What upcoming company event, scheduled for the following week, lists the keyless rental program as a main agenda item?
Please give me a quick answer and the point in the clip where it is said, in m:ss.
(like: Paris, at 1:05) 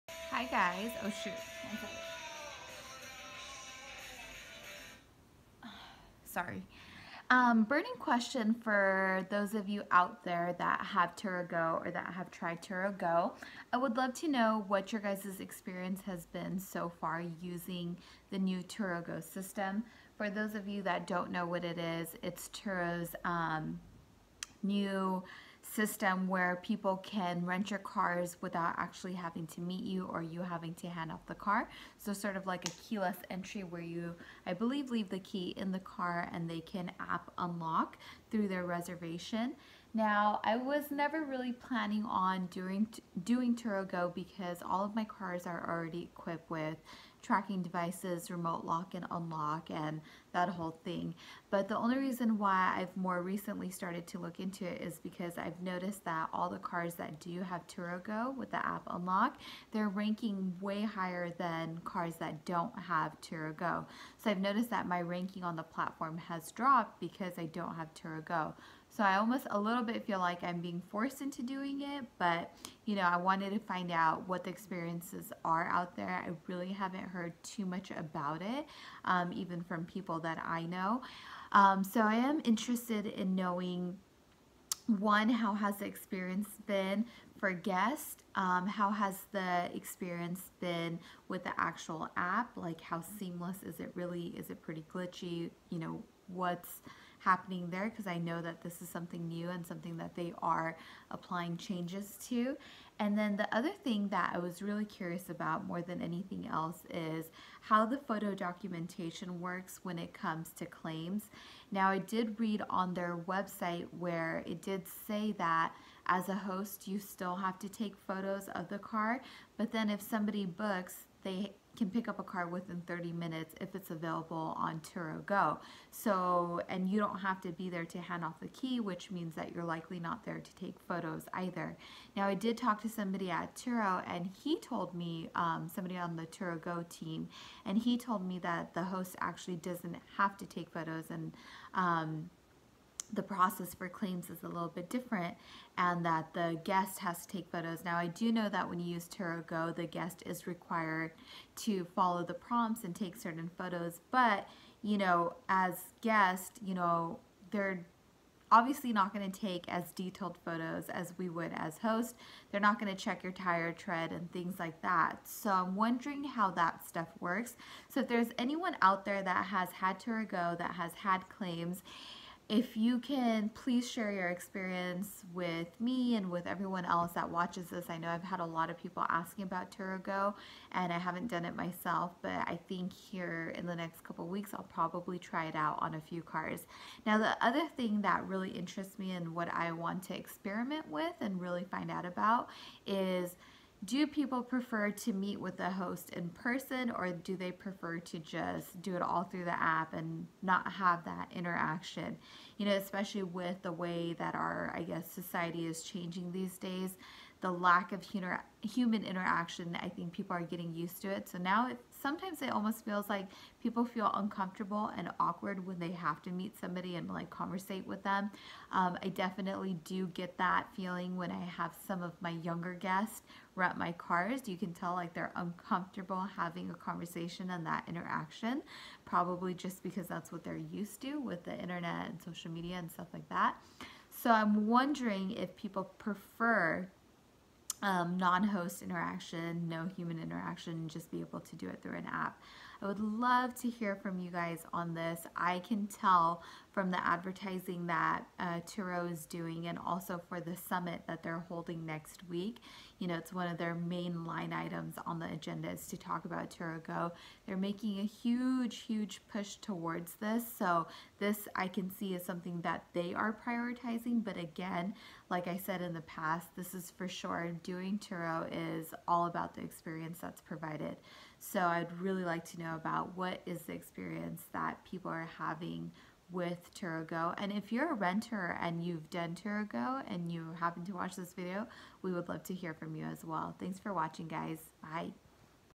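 the summit, at 4:10.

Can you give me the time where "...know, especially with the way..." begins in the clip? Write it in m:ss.
3:22.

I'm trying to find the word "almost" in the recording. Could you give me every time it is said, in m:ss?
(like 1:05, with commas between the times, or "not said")
1:09, 3:32.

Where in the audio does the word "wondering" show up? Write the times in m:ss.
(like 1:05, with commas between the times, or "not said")
2:45, 3:54.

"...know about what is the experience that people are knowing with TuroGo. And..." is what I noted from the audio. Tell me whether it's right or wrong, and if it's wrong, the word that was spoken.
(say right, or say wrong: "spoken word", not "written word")
wrong: "having", not "knowing".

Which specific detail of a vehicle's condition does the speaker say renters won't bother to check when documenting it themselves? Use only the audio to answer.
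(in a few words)
tire tread.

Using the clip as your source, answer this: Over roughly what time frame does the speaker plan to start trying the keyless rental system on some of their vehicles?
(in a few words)
next couple weeks.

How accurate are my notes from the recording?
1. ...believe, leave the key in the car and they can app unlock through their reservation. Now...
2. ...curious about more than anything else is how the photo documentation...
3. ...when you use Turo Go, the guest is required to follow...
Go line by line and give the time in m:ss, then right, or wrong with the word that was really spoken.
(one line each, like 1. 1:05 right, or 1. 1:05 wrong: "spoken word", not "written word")
1. 0:34 right
2. 1:44 right
3. 2:28 right.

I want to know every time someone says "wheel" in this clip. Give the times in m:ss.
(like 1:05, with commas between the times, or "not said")
not said.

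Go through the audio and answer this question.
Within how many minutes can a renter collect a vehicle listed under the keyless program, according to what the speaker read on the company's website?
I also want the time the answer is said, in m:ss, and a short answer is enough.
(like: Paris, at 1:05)
30 minutes, at 2:02.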